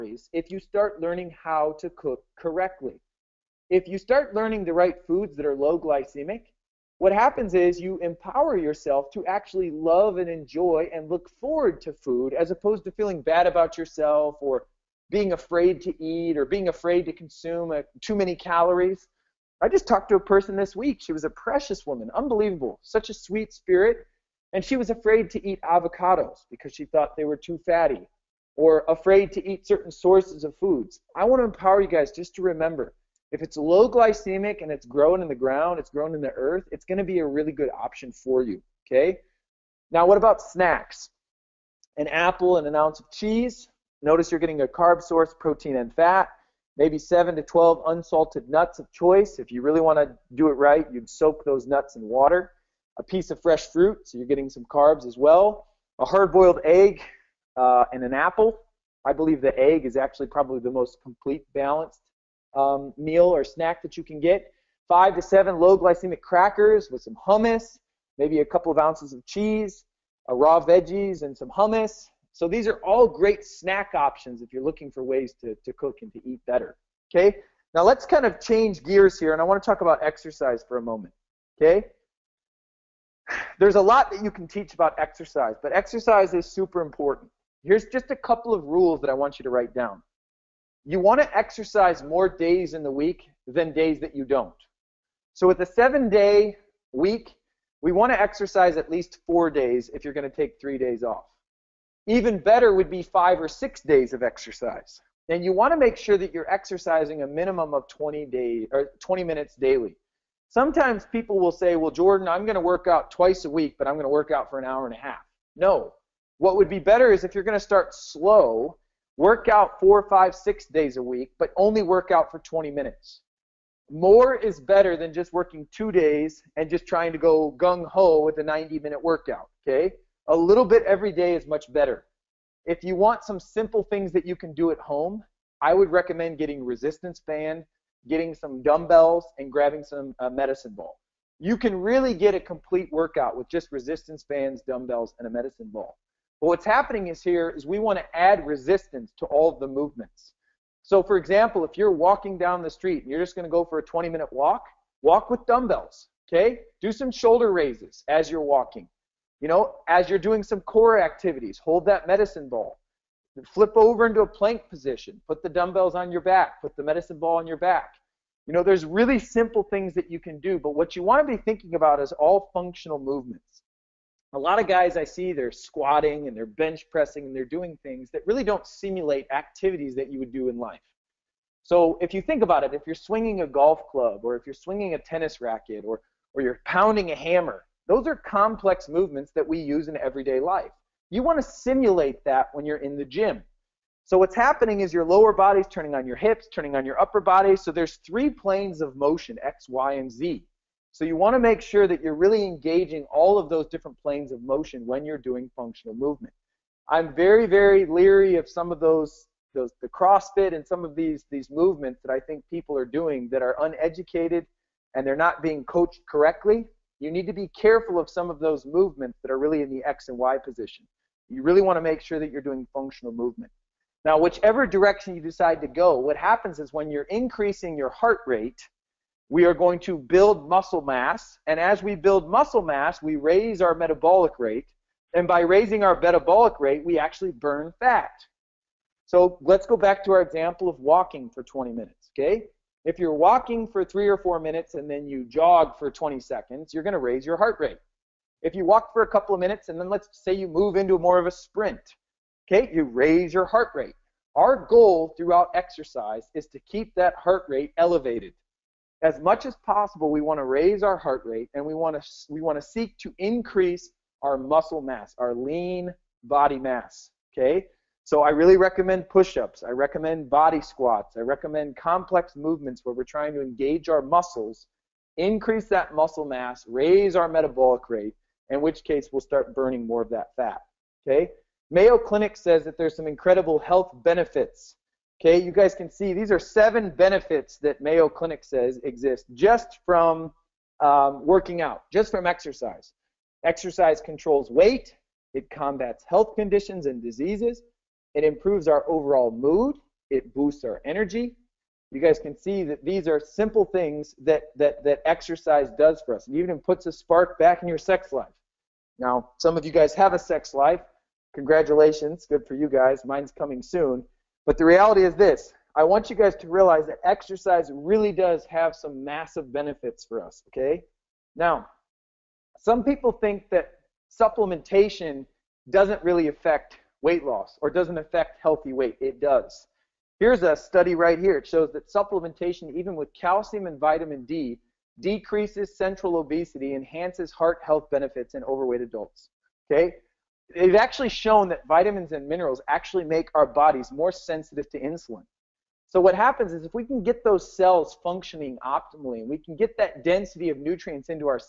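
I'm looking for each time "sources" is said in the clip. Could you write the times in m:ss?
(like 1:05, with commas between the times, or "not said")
0:29, 0:45.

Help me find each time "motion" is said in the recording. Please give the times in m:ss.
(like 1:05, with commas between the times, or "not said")
3:18, 3:24.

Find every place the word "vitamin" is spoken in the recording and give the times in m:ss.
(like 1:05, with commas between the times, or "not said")
5:33, 5:41.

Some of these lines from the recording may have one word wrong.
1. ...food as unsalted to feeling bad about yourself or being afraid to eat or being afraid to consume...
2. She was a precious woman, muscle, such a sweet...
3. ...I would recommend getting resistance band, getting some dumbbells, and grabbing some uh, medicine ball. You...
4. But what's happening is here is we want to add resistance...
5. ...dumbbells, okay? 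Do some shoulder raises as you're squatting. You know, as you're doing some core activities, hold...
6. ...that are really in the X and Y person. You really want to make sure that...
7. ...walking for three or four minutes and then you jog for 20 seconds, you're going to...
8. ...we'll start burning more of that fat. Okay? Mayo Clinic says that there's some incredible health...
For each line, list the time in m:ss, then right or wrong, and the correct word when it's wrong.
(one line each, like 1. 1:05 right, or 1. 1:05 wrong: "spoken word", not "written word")
1. 0:11 wrong: "opposed", not "unsalted"
2. 0:20 wrong: "unbelievable", not "muscle"
3. 2:15 right
4. 2:26 right
5. 2:35 wrong: "walking", not "squatting"
6. 3:39 wrong: "position", not "person"
7. 4:03 right
8. 4:39 right.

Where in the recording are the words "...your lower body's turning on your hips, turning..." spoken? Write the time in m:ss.
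3:14.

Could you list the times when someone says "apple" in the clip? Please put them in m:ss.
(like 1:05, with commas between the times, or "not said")
0:42, 0:58.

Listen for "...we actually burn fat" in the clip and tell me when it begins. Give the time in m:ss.
3:56.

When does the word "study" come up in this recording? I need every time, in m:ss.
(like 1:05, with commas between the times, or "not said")
5:30.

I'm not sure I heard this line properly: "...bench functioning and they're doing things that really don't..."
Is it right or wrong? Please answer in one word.
wrong.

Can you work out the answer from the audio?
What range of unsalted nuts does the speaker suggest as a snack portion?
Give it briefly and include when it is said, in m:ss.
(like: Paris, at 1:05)
7 to 12, at 0:46.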